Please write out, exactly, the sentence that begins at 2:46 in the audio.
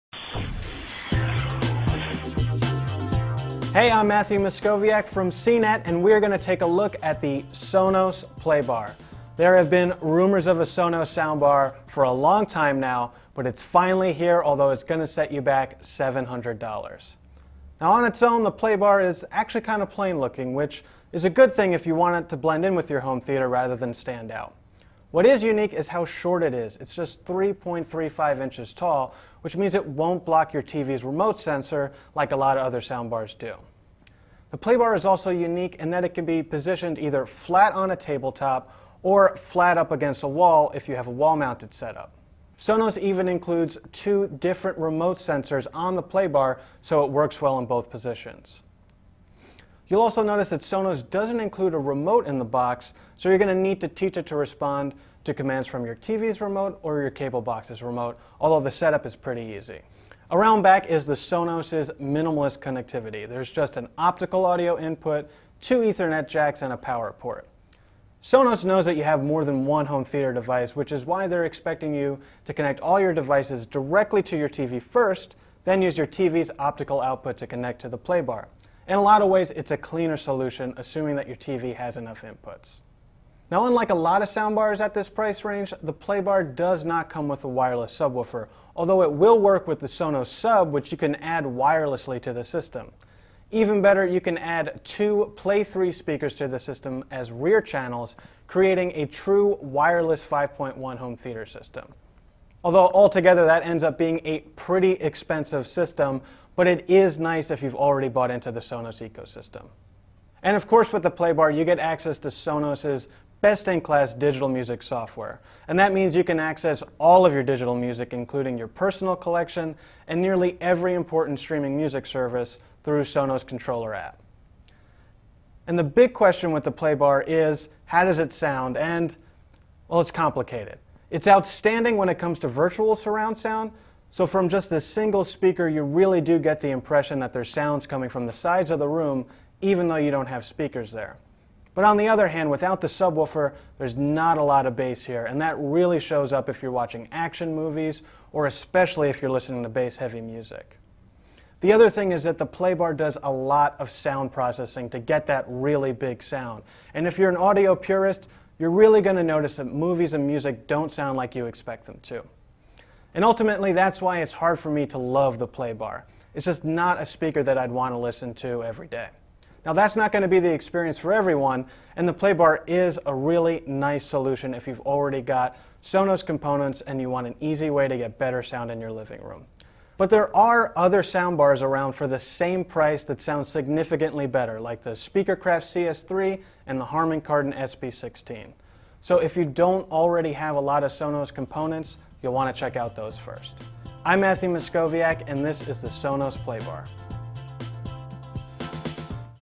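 It's just not a speaker that I'd want to listen to every day.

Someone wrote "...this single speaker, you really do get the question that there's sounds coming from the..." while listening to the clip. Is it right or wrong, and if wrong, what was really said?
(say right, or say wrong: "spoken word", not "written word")
wrong: "impression", not "question".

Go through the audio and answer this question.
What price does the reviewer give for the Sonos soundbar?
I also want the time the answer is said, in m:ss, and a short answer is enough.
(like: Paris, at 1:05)
$700, at 0:15.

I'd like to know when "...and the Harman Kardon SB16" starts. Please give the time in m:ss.
3:06.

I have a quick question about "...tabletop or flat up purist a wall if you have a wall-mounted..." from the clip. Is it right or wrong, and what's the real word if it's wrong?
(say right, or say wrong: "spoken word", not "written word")
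wrong: "against", not "purist".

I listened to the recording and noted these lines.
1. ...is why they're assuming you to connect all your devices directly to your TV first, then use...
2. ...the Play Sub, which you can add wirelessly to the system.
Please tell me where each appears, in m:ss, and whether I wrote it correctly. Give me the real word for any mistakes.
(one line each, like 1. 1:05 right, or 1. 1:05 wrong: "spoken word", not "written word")
1. 1:10 wrong: "expecting", not "assuming"
2. 1:29 wrong: "Sonos", not "Play".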